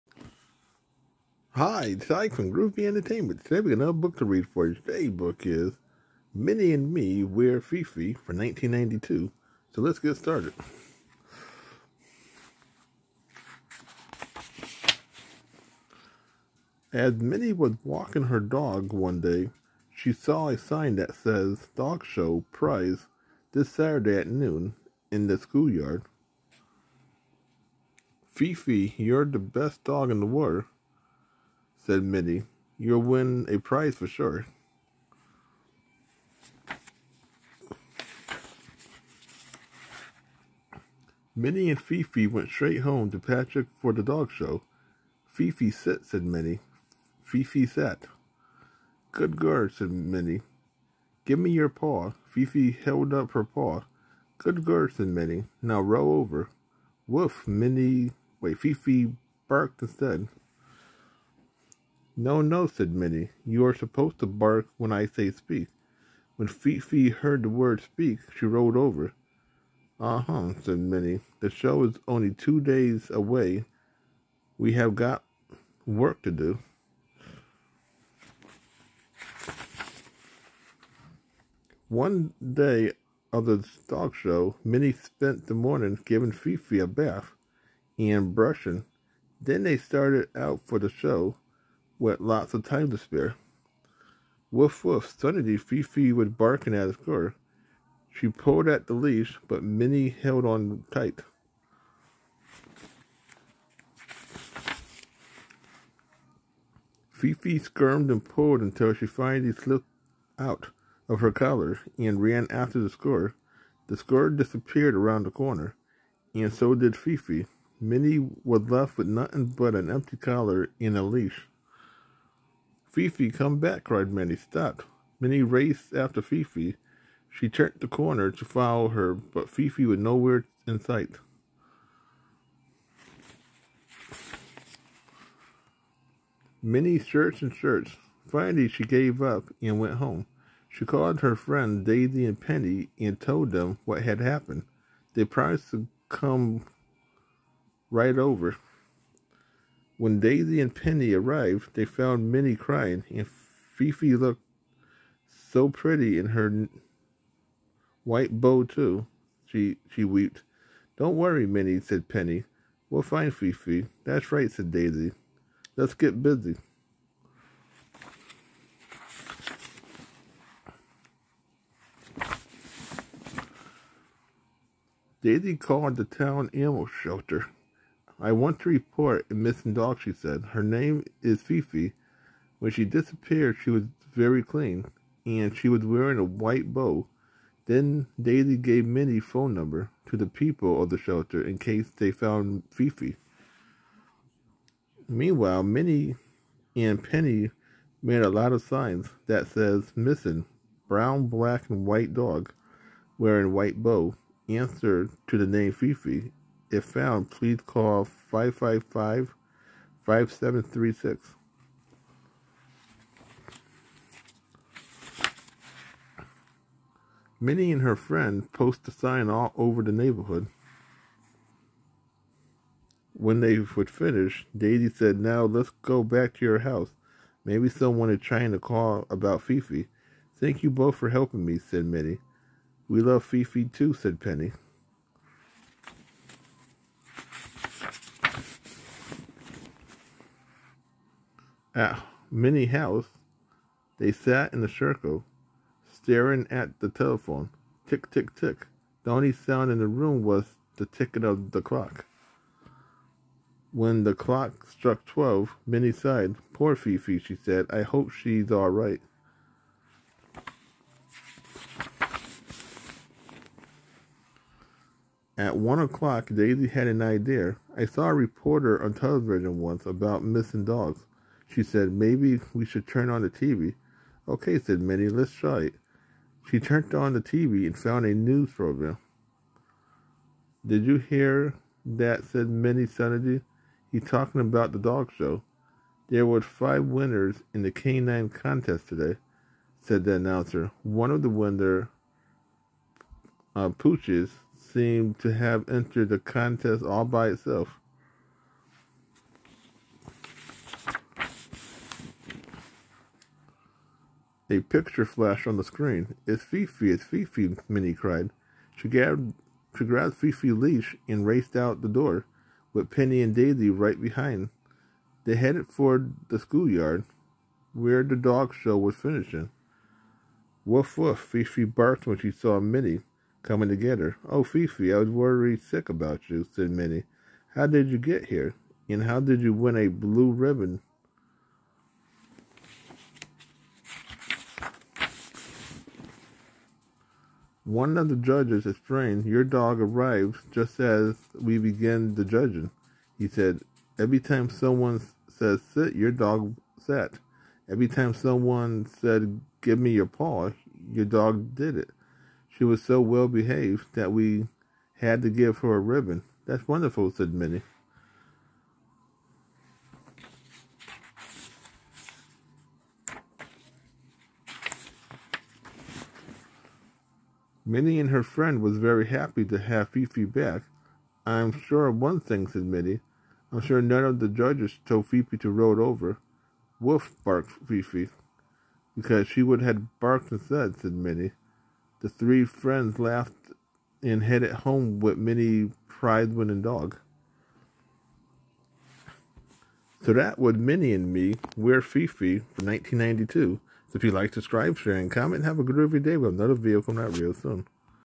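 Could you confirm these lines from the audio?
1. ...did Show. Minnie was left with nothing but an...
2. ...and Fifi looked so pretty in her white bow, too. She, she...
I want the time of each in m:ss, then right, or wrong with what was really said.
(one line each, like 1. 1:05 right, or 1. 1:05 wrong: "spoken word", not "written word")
1. 1:56 wrong: "Fifi", not "Show"
2. 2:33 right.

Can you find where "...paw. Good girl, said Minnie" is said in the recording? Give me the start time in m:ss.
0:53.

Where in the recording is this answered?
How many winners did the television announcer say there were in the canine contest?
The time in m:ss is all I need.
4:46.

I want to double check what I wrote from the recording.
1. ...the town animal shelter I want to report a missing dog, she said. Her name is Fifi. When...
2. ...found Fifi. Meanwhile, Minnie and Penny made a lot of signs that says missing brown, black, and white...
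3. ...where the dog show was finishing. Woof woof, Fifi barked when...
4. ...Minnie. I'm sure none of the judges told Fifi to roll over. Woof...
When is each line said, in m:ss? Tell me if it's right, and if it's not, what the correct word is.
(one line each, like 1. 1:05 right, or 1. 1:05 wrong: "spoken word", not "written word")
1. 2:55 right
2. 3:12 right
3. 5:17 right
4. 6:12 right.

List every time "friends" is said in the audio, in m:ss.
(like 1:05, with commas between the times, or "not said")
2:21, 3:37, 6:08, 6:22.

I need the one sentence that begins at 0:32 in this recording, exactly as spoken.
You'll win a prize for sure.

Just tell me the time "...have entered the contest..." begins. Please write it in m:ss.
4:55.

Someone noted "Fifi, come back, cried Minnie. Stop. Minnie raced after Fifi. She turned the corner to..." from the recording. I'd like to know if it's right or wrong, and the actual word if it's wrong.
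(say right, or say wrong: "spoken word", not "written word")
right.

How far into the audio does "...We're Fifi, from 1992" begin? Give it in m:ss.
6:31.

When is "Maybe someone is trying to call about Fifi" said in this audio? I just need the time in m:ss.
3:47.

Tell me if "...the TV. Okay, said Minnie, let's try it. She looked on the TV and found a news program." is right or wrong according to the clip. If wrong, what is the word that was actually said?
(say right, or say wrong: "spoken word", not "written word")
wrong: "turned", not "looked".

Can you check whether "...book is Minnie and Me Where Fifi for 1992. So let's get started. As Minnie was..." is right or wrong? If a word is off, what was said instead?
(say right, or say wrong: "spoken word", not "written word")
right.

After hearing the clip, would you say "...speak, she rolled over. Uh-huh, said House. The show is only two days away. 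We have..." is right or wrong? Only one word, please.
wrong.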